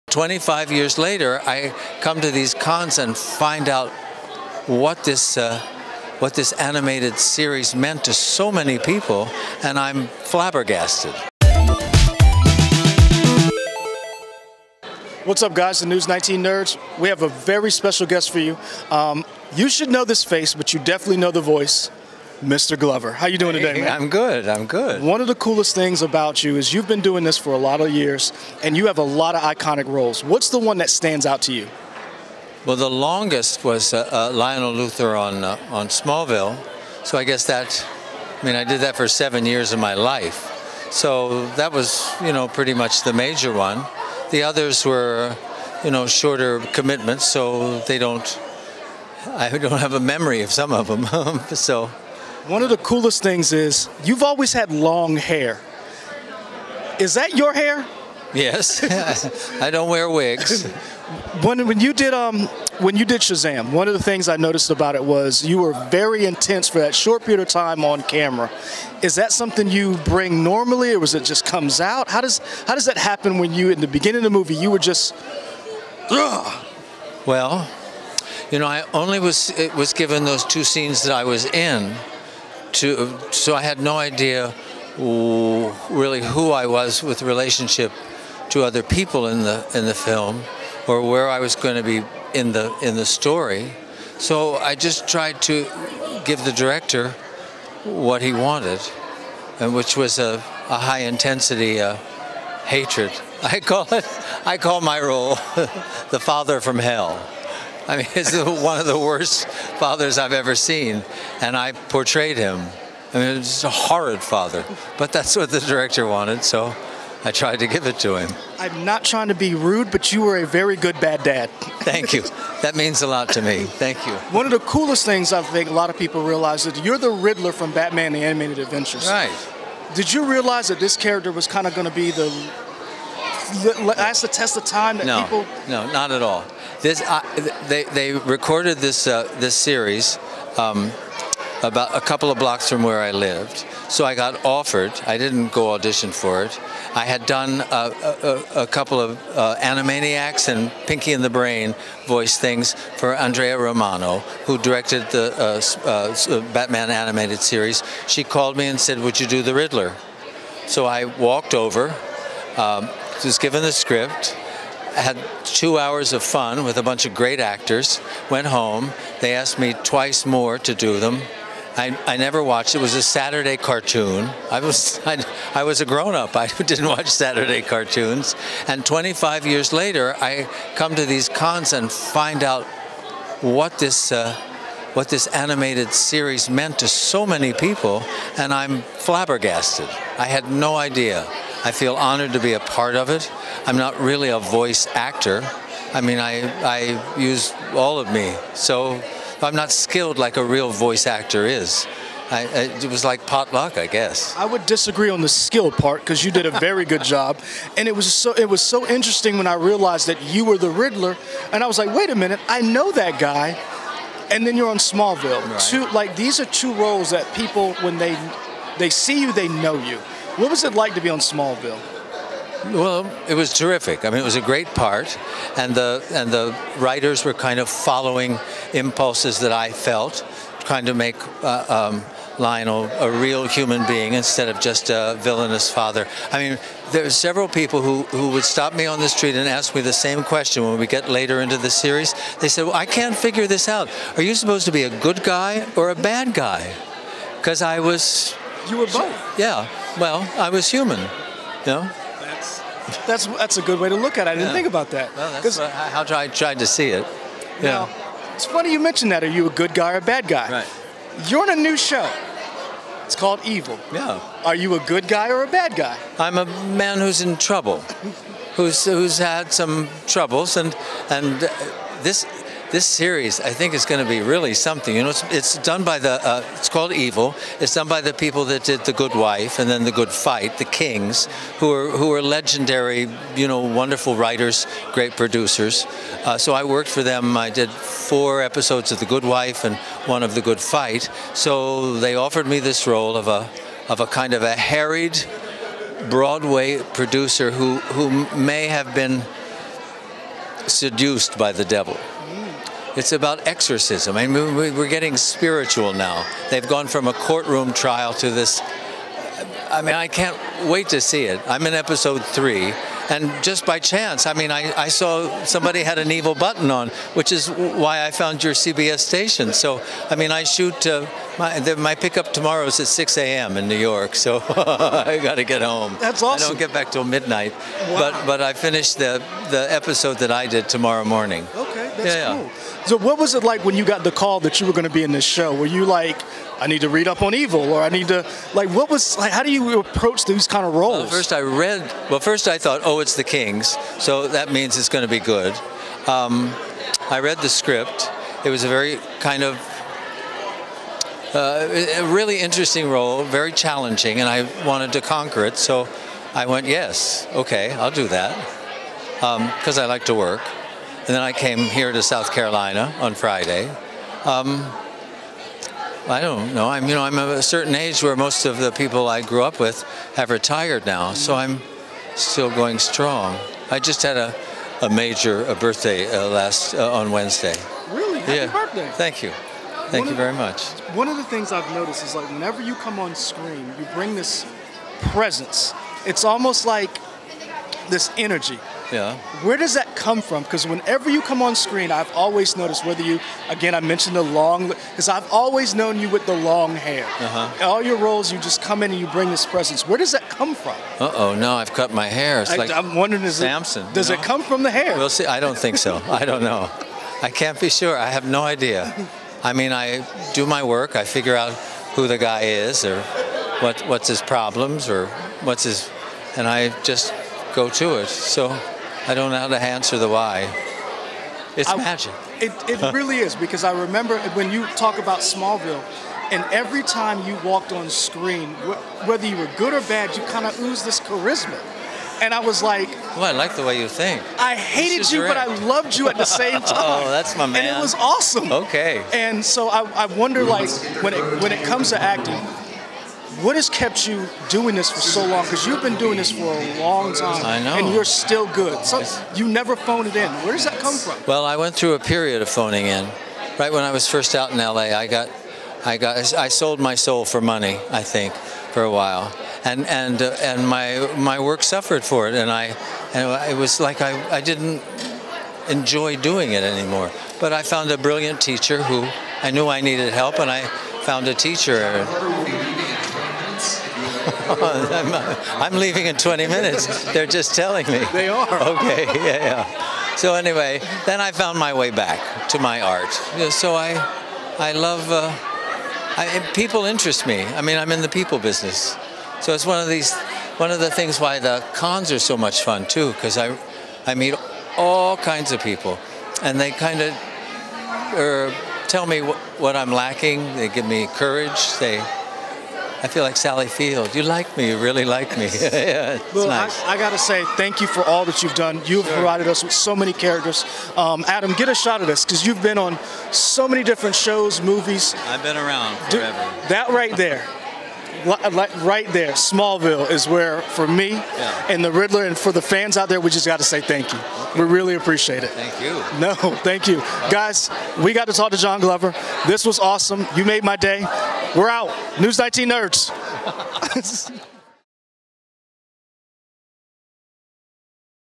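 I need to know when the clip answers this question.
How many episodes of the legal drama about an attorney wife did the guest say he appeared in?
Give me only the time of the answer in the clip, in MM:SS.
04:47.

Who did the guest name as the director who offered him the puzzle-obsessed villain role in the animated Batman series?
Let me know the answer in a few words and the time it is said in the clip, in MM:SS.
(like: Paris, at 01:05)
Andrea Romano, at 02:33.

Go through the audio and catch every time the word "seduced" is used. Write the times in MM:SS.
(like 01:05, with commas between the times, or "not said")
05:00.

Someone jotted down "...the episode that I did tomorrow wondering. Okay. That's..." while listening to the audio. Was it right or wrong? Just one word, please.
wrong.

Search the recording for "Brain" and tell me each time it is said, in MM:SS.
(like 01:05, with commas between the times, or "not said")
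02:31.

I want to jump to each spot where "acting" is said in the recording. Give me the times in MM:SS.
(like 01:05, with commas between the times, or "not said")
07:22.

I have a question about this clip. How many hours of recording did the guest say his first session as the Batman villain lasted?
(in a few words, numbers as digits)
2.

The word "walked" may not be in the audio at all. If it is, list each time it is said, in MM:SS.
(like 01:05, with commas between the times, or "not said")
02:41, 07:07.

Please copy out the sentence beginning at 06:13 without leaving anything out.
I just had a, a major a birthday uh, last uh, on Wednesday.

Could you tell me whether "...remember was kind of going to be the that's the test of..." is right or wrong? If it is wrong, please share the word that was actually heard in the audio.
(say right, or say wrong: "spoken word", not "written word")
wrong: "character", not "remember".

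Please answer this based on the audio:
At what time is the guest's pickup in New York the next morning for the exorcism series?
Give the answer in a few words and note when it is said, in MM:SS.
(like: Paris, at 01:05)
6 a.m., at 05:22.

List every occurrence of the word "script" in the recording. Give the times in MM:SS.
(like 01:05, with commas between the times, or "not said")
02:43, 05:47.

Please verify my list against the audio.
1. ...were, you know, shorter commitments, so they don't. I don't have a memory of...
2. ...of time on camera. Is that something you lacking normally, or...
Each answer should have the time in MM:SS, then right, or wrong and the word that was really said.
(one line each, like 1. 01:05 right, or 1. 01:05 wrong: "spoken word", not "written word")
1. 00:44 right
2. 01:07 wrong: "bring", not "lacking".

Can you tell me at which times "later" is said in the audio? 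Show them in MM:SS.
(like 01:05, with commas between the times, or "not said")
00:00, 02:59, 04:01.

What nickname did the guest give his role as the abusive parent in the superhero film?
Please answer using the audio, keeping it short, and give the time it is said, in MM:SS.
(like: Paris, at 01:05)
The father from hell, at 01:46.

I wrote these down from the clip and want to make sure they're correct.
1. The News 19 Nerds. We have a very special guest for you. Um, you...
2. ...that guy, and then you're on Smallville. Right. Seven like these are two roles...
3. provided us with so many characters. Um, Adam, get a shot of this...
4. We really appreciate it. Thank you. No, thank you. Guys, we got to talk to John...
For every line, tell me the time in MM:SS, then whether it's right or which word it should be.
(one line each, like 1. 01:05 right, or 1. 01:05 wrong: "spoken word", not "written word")
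1. 00:15 right
2. 03:32 wrong: "Two", not "Seven"
3. 08:29 right
4. 08:44 right.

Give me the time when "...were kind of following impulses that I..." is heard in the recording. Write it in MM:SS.
03:47.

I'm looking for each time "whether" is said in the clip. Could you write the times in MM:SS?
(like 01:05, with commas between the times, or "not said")
06:32, 07:09.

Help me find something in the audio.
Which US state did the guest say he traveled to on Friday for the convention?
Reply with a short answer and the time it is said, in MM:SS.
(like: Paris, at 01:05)
South Carolina, at 06:02.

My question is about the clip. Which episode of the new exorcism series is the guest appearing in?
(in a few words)
Episode 3.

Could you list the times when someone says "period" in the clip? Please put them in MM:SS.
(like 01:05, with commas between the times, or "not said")
01:07, 07:31.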